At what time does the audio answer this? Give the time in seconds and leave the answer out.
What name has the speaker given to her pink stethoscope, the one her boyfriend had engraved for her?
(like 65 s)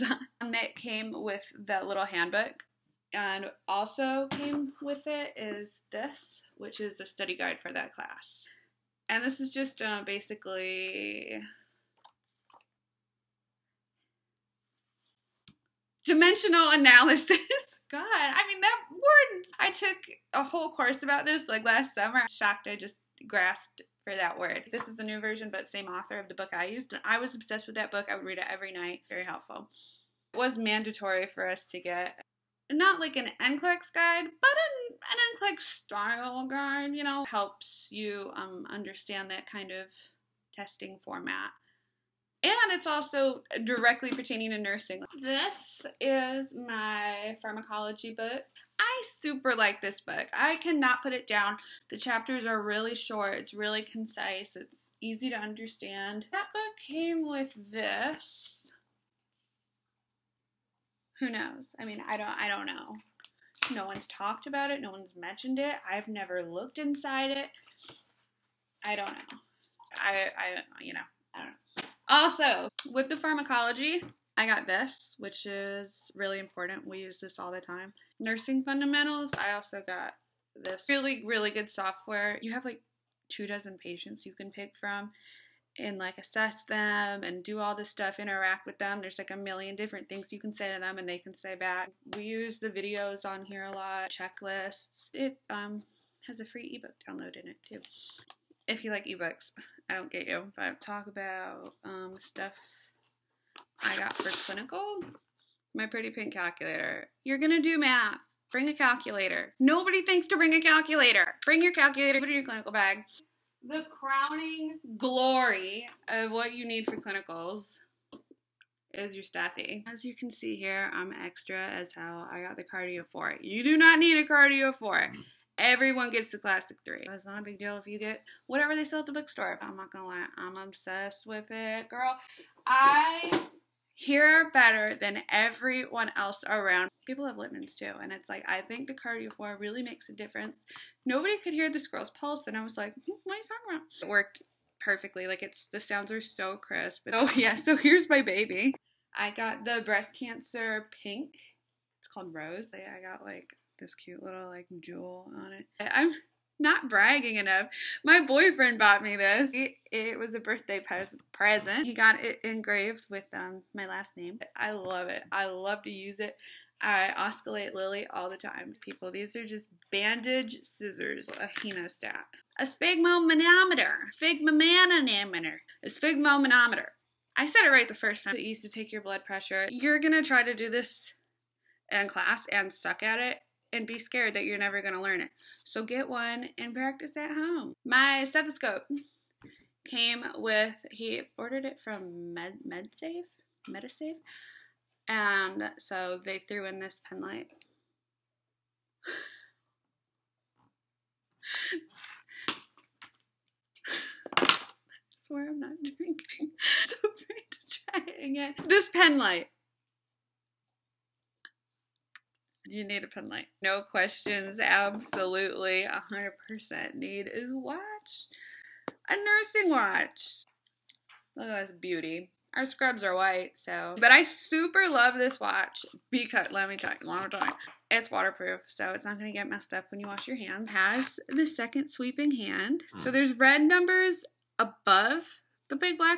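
152 s.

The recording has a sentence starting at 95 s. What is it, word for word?
It um, has a free ebook download in it too.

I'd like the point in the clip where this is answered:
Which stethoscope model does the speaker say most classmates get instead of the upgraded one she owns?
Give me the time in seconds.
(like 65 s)
126 s.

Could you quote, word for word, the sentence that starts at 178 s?
It used to take your blood pressure.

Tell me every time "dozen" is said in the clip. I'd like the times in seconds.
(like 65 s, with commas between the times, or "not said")
83 s.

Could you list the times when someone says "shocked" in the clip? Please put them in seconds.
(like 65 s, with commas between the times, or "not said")
22 s.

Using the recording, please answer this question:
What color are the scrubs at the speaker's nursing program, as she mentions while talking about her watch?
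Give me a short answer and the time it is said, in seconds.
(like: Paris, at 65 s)
white, at 223 s.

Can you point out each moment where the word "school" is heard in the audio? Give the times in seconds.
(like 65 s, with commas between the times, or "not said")
not said.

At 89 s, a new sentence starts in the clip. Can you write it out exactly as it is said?
There's like a million different things you can say to them and they can say back.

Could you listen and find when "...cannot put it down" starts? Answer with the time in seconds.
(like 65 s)
50 s.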